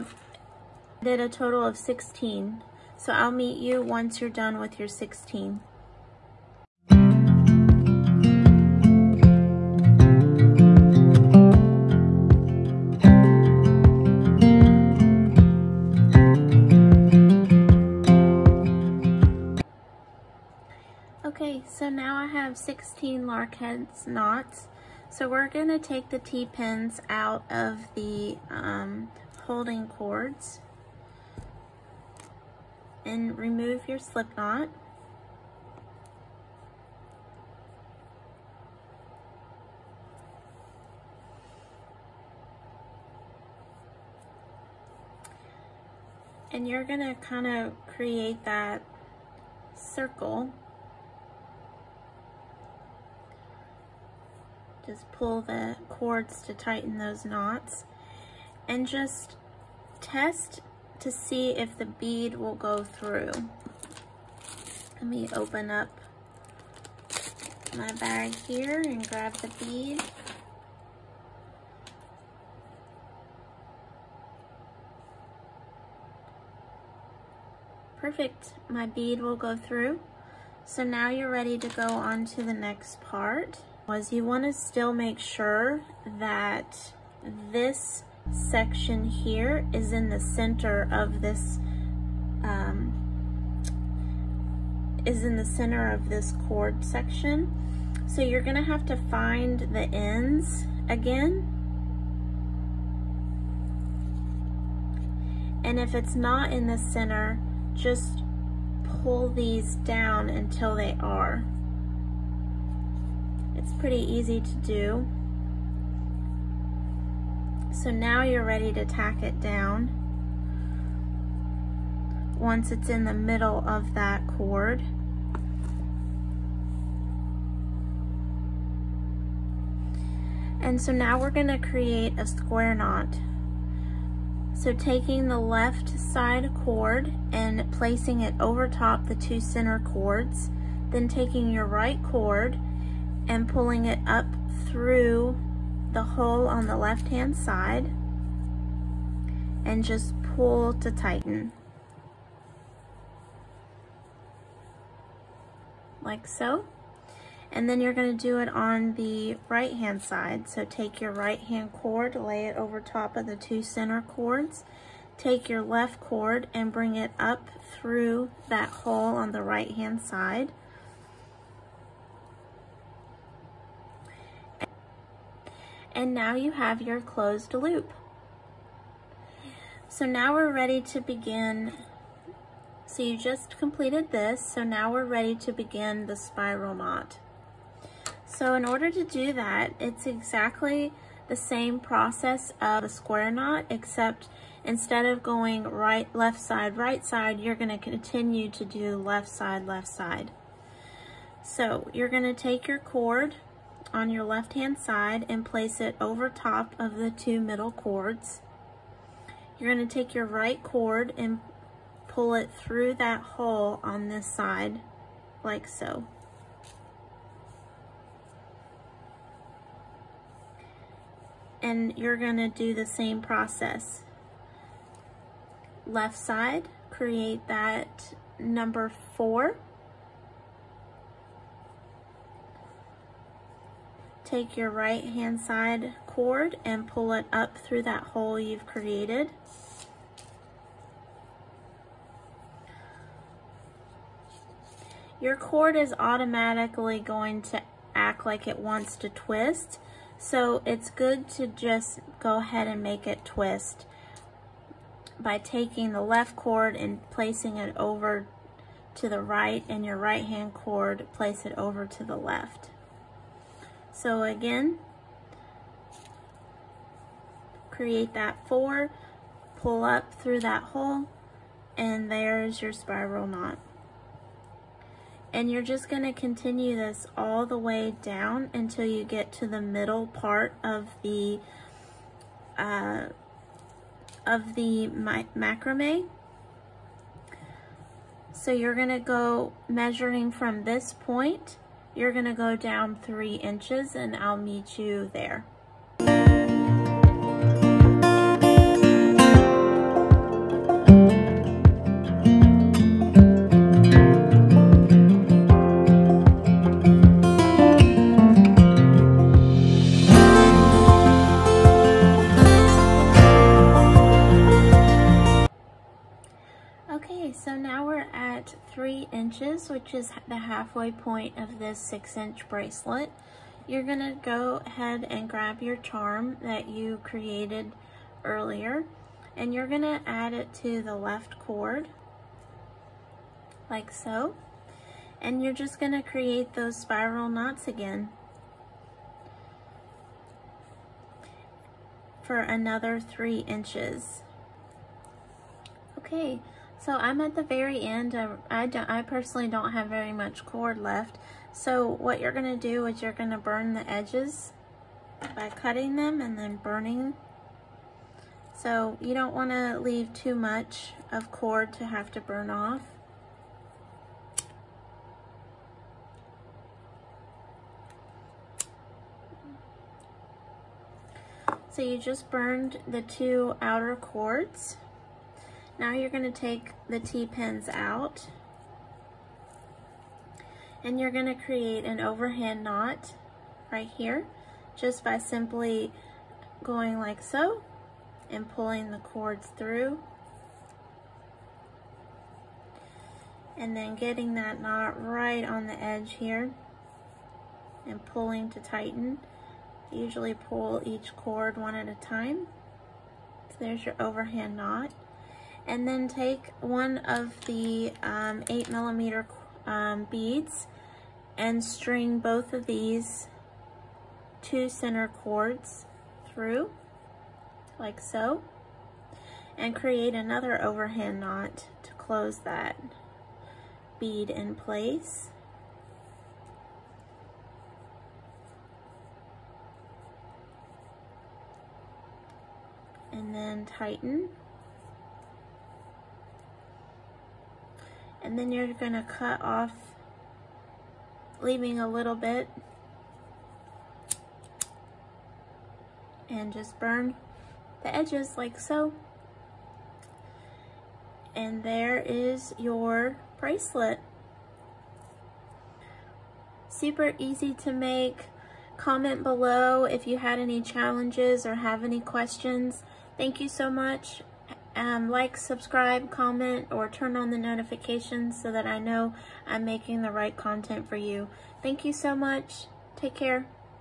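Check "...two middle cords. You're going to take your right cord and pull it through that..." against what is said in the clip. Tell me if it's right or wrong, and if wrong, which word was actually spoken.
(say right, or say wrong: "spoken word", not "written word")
right.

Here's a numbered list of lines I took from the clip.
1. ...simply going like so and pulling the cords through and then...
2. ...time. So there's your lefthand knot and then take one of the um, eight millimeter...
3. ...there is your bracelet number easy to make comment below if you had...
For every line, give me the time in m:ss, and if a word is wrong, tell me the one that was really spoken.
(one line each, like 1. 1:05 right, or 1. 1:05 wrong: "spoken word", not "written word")
1. 6:25 right
2. 6:42 wrong: "overhand", not "lefthand"
3. 7:31 wrong: "super", not "number".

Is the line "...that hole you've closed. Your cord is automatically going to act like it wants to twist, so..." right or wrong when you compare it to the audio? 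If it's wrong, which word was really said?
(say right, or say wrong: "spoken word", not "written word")
wrong: "created", not "closed".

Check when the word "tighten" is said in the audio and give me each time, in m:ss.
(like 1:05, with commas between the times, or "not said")
0:56, 2:30, 6:38, 7:13.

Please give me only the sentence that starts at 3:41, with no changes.
And you're going to do the same process.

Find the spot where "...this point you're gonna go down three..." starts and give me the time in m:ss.
4:50.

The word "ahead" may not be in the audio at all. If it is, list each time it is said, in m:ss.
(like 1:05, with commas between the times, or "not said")
4:12, 5:24.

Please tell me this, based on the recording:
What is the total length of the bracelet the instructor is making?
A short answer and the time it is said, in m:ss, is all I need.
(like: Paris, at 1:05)
6 inches, at 5:21.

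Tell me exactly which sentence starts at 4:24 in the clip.
So again, create that four, pull up through that hole, and there's your spiral knot.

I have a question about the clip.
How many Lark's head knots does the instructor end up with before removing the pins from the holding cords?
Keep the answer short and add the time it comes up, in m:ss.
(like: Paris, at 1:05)
16, at 0:22.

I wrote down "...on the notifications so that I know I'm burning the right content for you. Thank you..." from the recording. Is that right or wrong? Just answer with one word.
wrong.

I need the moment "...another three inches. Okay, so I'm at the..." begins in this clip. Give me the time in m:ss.
5:42.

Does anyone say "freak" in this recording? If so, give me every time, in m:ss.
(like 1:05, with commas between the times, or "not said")
not said.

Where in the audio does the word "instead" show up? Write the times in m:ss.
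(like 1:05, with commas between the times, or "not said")
3:14.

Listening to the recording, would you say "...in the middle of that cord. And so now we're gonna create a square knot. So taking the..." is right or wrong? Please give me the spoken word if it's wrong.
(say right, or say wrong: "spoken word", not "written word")
right.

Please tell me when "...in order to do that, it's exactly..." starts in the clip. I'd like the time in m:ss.
3:08.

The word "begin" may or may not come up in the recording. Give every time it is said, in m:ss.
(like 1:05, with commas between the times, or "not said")
3:01, 3:05.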